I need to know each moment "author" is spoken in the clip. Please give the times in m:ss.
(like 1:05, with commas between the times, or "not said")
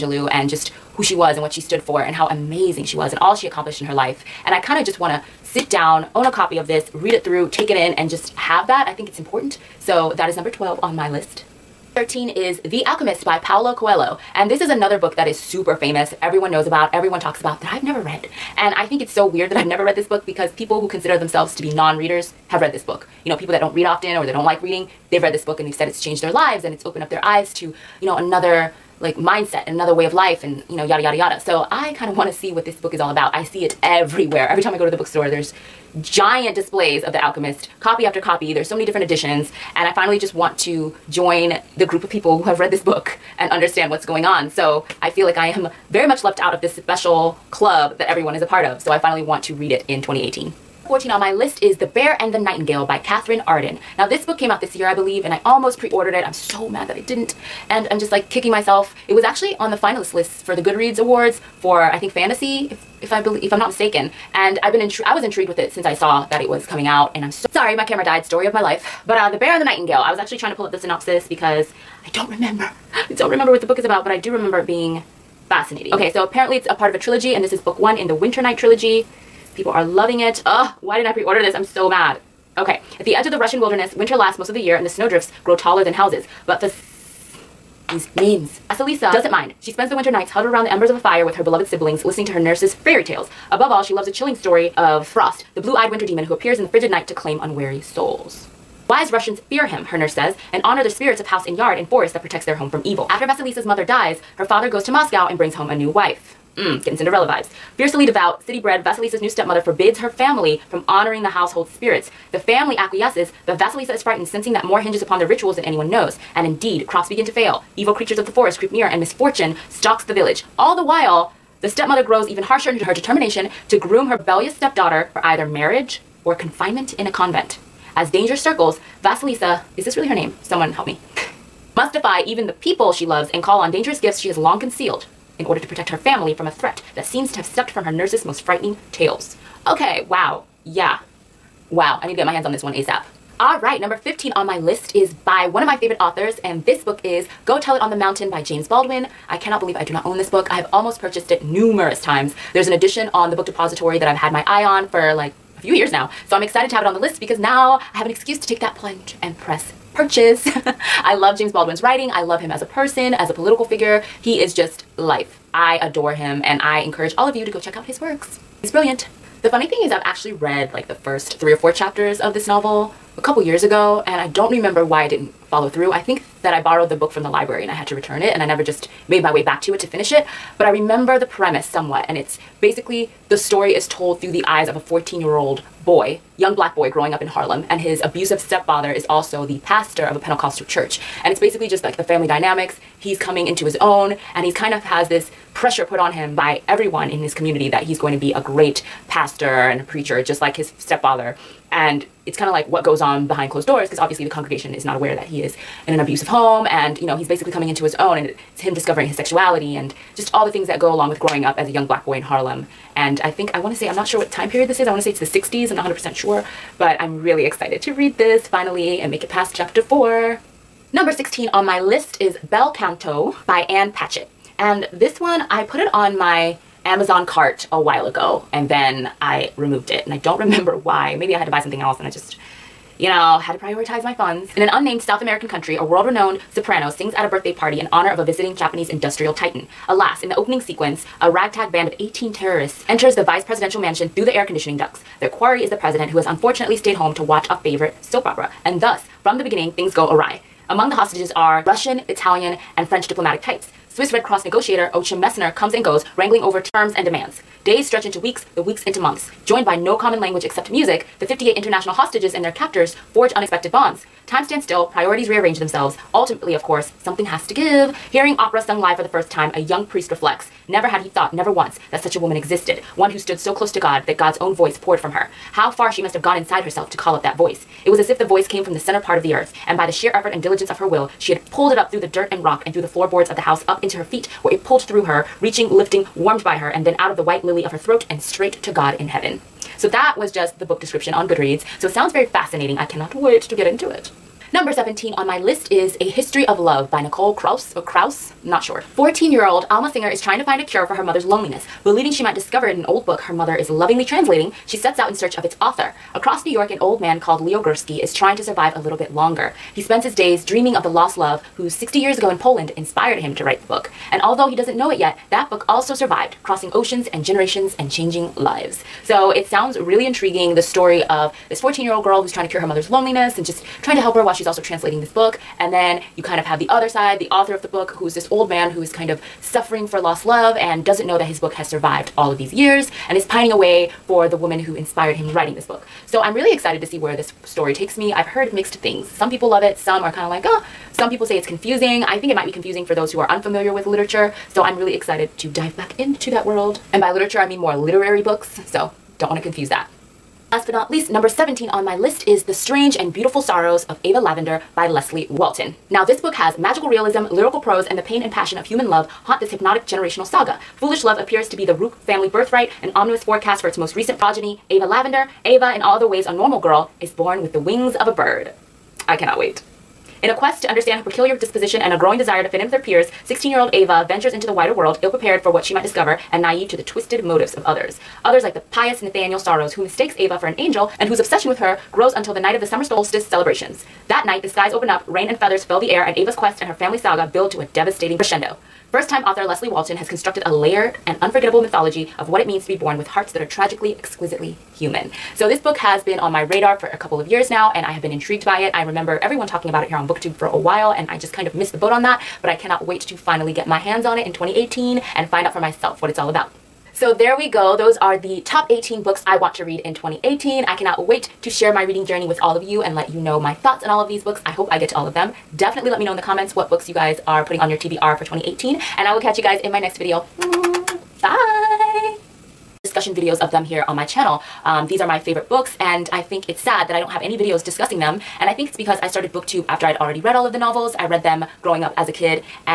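2:26, 5:05, 5:27, 6:29.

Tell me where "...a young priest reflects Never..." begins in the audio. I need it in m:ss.
4:29.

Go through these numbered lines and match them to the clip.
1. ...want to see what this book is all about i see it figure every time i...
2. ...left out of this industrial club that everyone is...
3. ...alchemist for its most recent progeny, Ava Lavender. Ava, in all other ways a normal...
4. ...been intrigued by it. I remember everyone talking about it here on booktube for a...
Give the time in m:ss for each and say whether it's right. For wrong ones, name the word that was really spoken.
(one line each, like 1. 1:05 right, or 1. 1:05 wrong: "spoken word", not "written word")
1. 0:32 wrong: "everywhere", not "figure"
2. 0:46 wrong: "special", not "industrial"
3. 6:03 wrong: "forecast", not "alchemist"
4. 6:38 right.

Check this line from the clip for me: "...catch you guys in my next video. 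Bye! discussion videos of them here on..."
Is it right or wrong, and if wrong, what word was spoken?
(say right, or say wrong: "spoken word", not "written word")
right.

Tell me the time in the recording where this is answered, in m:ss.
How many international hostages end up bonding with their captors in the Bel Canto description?
4:21.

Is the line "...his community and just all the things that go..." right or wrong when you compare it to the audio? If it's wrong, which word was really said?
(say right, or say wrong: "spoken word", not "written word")
wrong: "sexuality", not "community".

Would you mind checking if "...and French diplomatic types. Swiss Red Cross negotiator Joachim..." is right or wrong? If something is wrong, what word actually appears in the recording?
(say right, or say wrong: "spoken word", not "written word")
right.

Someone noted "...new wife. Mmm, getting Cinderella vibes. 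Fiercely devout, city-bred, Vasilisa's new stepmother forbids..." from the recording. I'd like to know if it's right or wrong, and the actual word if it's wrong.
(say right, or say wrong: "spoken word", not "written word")
right.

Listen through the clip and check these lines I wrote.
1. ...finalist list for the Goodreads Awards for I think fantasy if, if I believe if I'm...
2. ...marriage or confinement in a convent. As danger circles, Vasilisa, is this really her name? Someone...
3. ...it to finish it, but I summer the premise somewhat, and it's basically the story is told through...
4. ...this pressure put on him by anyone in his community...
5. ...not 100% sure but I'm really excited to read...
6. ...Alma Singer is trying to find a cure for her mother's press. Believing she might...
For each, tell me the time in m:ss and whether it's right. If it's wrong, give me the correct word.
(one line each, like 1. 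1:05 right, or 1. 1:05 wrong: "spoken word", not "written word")
1. 0:59 right
2. 2:05 right
3. 2:59 wrong: "remember", not "summer"
4. 3:15 wrong: "everyone", not "anyone"
5. 3:35 right
6. 4:59 wrong: "loneliness", not "press".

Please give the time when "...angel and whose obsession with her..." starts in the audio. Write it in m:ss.
6:20.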